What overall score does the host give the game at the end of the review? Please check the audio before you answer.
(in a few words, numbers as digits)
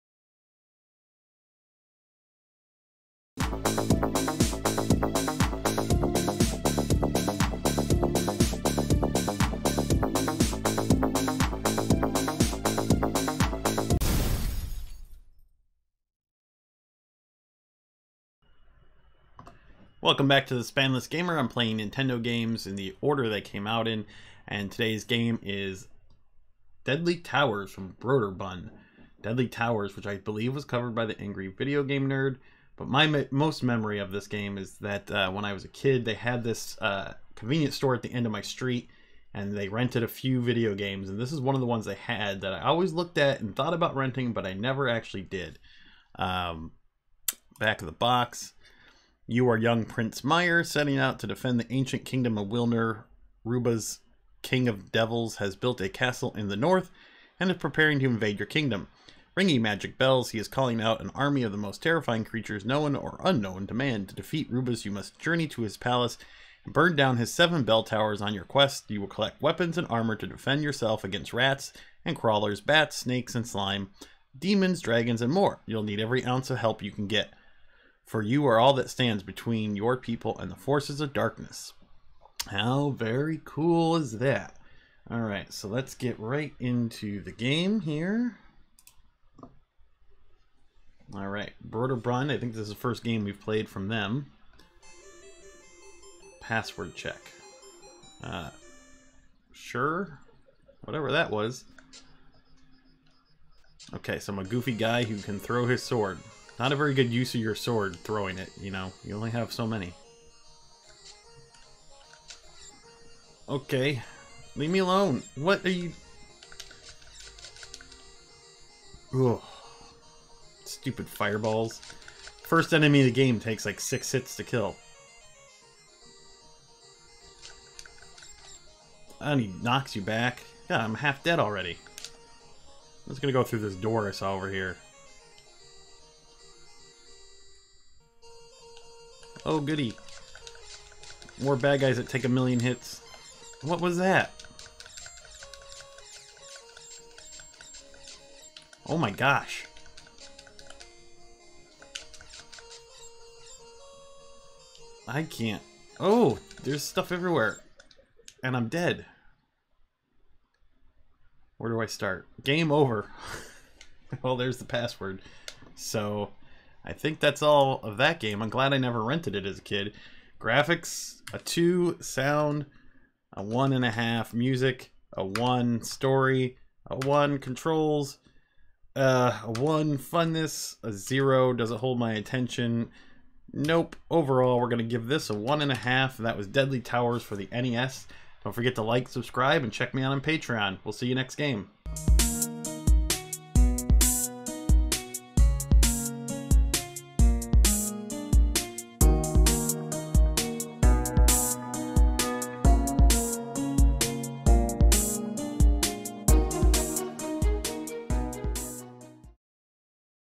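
1.5.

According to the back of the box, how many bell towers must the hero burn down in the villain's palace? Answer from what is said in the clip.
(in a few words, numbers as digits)
7.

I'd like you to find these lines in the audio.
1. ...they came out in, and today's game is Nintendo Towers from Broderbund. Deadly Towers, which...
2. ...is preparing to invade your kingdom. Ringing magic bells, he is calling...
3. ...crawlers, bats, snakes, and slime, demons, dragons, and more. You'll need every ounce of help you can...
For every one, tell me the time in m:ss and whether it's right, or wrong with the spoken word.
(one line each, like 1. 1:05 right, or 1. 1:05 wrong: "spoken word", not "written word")
1. 0:23 wrong: "Deadly", not "Nintendo"
2. 0:57 right
3. 1:12 right.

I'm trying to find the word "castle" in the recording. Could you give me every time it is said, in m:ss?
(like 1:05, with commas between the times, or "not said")
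0:55.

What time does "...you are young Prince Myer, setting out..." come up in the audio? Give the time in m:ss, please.
0:49.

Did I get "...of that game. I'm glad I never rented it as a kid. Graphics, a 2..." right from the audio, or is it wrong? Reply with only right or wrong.
right.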